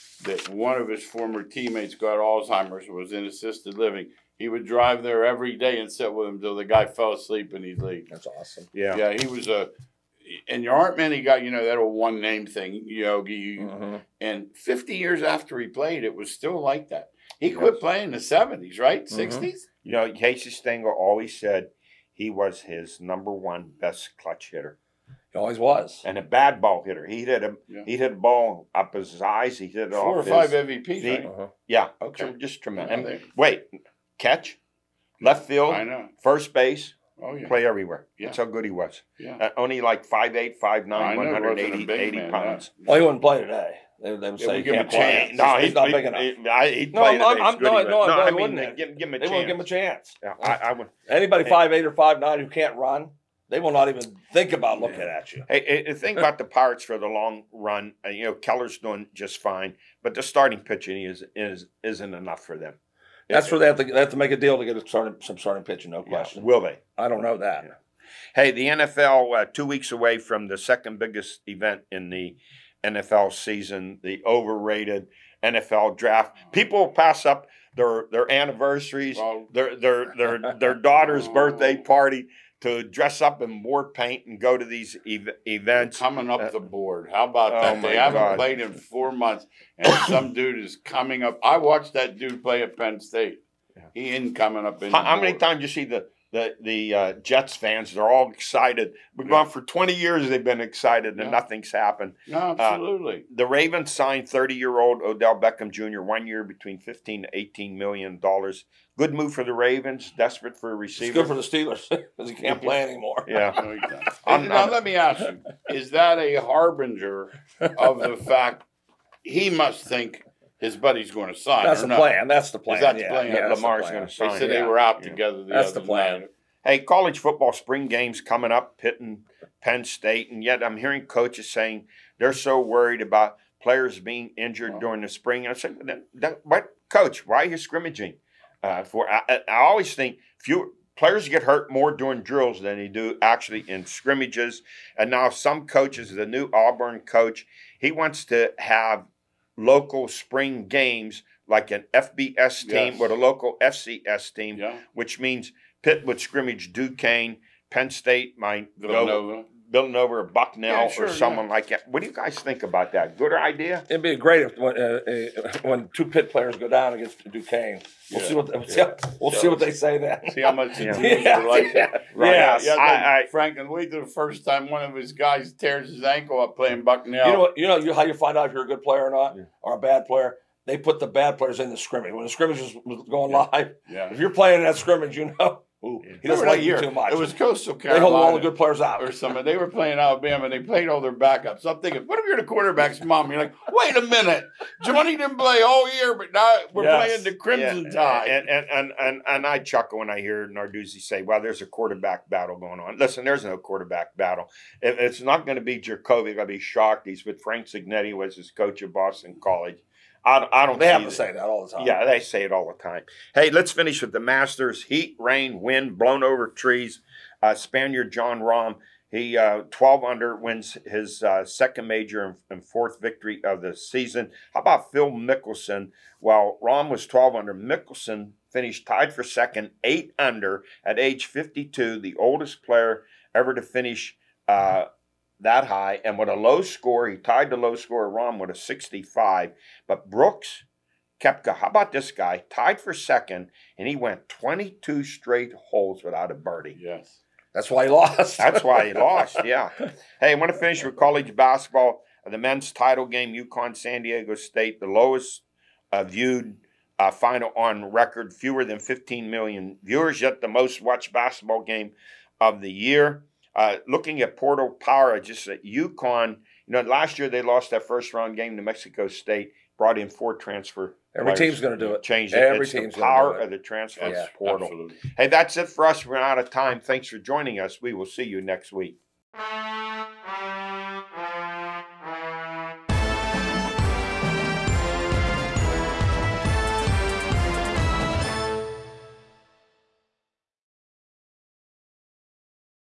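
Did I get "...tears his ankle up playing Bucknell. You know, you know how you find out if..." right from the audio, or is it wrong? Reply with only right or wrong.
right.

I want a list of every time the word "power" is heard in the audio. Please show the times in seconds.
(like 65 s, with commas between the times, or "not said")
264 s, 273 s.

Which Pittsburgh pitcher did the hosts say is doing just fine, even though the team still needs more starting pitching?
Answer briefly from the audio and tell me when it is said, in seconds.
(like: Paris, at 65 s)
Keller, at 58 s.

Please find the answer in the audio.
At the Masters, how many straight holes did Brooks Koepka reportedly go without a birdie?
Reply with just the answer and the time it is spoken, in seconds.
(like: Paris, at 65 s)
22, at 244 s.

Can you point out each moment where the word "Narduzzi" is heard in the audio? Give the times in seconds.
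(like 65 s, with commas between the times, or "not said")
200 s.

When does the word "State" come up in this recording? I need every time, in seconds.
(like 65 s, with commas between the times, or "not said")
93 s, 129 s, 157 s, 254 s, 269 s.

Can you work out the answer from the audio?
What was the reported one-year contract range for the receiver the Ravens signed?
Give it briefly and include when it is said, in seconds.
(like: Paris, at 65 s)
15 to 18 million dollars, at 106 s.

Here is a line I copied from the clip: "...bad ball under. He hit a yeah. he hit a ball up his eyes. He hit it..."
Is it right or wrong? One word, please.
wrong.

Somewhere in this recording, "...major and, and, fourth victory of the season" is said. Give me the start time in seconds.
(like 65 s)
221 s.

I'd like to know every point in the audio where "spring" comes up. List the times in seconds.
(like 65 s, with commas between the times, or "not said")
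127 s, 135 s, 150 s.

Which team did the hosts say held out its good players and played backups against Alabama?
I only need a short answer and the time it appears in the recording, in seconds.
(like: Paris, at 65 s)
Coastal Carolina, at 187 s.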